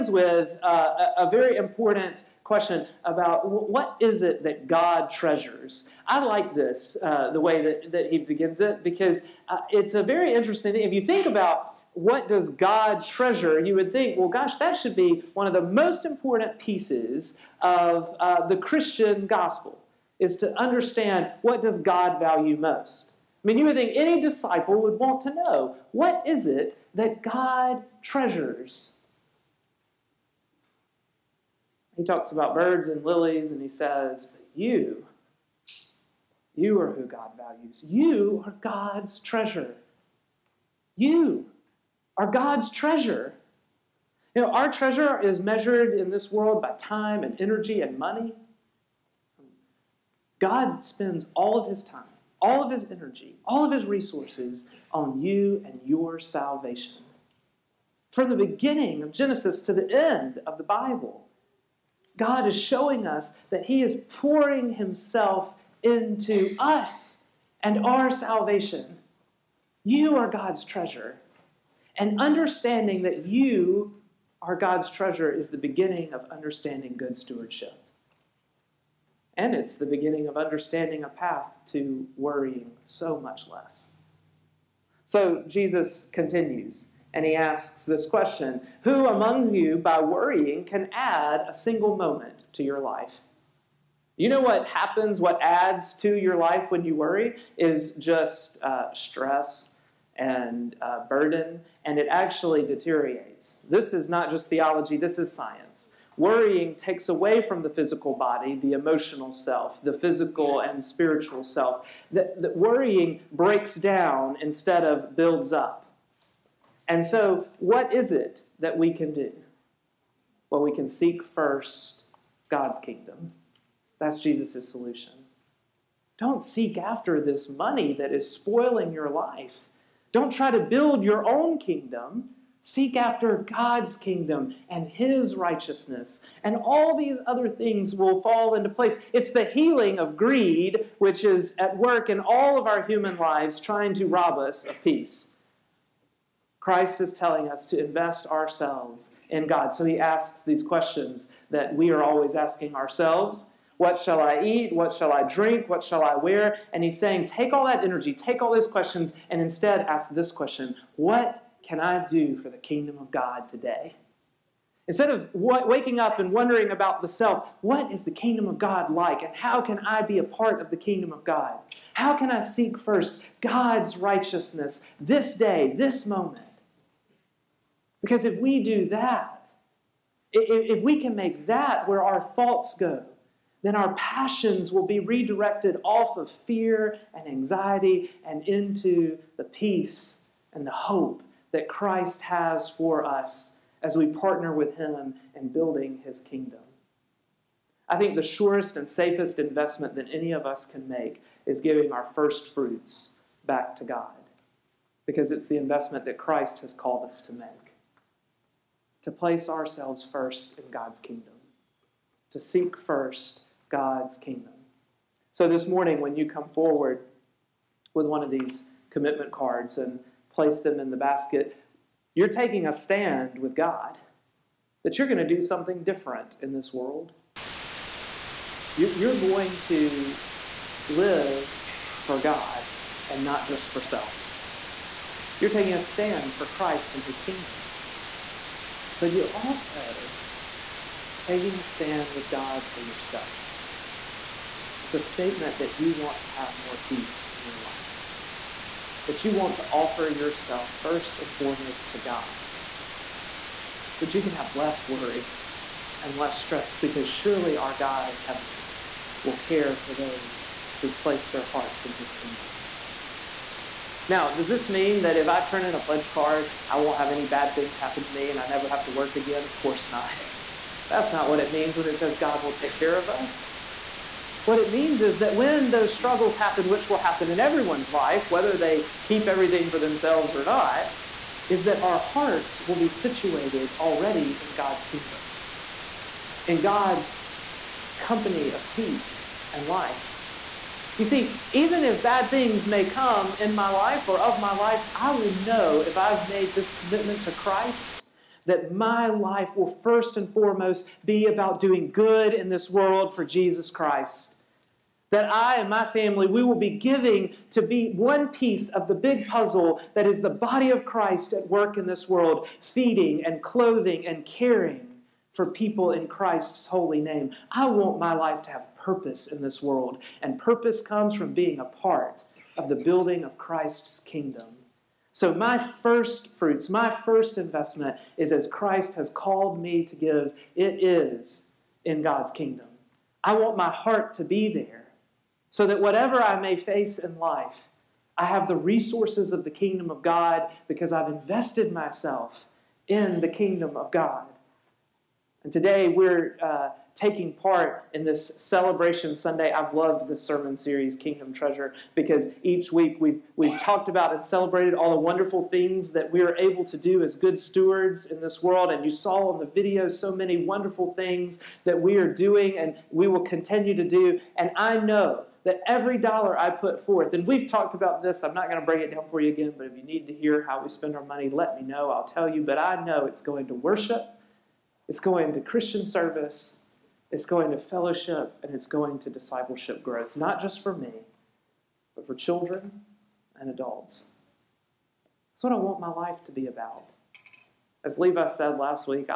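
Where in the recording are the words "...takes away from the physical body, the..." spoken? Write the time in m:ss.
1:46.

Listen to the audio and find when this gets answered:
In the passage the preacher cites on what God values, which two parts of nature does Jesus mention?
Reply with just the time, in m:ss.
0:32.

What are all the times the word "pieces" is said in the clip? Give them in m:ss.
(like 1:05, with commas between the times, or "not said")
0:16, 5:08.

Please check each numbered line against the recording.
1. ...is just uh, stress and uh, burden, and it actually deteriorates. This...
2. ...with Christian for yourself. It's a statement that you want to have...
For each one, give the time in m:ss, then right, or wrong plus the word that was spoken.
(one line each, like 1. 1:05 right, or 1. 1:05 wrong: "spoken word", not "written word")
1. 1:37 right
2. 4:02 wrong: "God", not "Christian".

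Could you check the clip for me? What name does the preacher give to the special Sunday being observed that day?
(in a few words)
Celebration Sunday.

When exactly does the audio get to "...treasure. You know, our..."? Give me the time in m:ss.
0:42.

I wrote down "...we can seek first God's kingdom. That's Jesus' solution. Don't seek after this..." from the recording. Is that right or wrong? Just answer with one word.
right.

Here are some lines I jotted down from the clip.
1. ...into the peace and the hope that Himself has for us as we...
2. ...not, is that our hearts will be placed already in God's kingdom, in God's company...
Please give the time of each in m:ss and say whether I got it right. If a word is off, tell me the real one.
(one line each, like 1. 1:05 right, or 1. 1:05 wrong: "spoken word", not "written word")
1. 3:08 wrong: "Christ", not "Himself"
2. 4:40 wrong: "situated", not "placed".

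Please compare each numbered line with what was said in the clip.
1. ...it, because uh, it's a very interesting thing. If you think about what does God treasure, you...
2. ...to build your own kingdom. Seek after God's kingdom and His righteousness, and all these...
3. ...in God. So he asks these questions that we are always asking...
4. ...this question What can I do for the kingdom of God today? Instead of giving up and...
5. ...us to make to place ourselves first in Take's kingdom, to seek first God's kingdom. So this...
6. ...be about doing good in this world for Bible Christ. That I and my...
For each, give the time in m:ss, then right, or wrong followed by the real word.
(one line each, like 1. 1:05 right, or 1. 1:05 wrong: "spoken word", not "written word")
1. 0:08 right
2. 2:10 right
3. 2:29 right
4. 2:40 wrong: "waking", not "giving"
5. 3:27 wrong: "God", not "Take"
6. 5:01 wrong: "Jesus", not "Bible".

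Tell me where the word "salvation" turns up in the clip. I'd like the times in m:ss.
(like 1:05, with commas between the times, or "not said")
0:56, 1:08.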